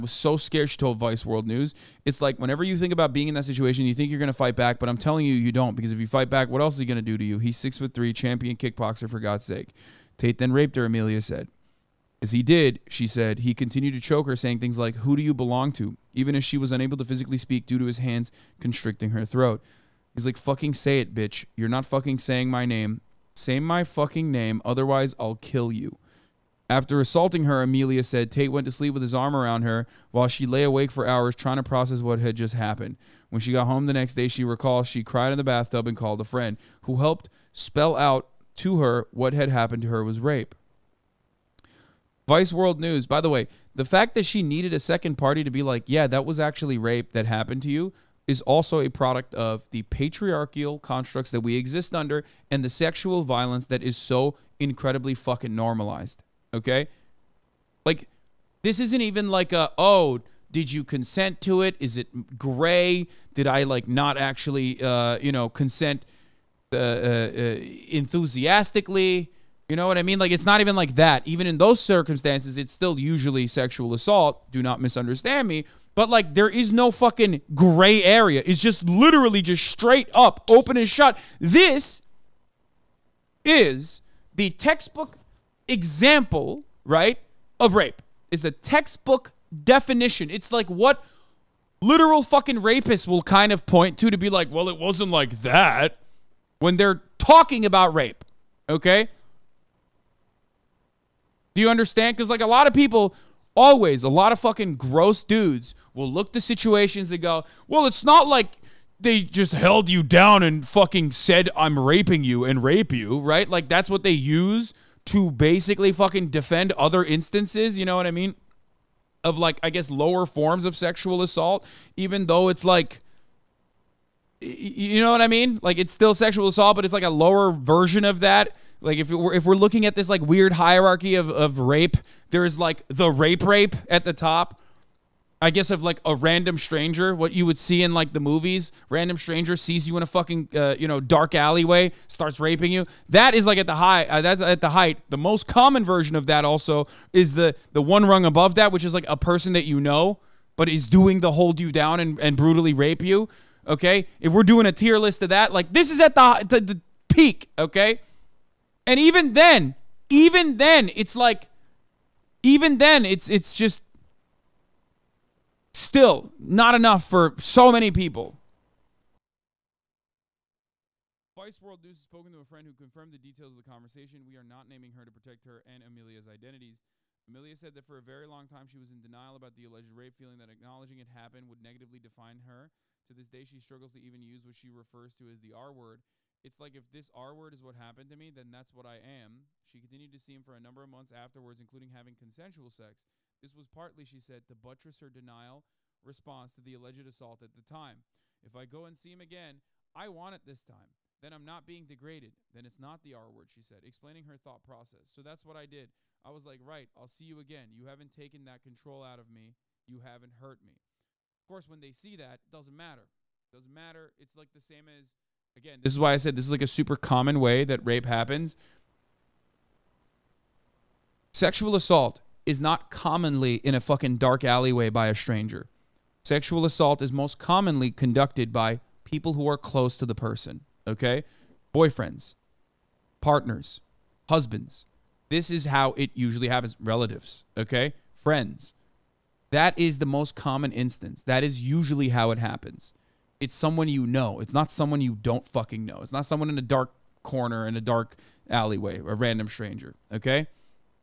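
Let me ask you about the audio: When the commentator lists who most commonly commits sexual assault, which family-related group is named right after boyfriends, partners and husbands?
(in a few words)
Relatives.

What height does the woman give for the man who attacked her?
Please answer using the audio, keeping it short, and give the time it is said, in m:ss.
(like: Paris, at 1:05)
6 foot 3, at 0:07.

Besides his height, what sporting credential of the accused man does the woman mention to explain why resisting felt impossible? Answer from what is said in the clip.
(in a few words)
champion kickboxer.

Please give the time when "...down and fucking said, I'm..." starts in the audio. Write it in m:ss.
1:50.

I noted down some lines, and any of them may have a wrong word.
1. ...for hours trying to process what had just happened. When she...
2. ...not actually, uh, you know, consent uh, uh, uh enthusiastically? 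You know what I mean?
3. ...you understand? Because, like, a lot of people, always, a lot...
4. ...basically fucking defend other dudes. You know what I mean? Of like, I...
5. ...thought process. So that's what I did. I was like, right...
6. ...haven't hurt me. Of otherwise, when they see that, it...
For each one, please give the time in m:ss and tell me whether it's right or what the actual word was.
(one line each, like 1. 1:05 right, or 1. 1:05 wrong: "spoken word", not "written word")
1. 0:30 right
2. 1:03 right
3. 1:41 right
4. 1:55 wrong: "instances", not "dudes"
5. 3:24 right
6. 3:29 wrong: "course", not "otherwise".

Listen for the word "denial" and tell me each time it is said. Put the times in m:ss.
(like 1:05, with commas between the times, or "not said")
2:59, 3:15.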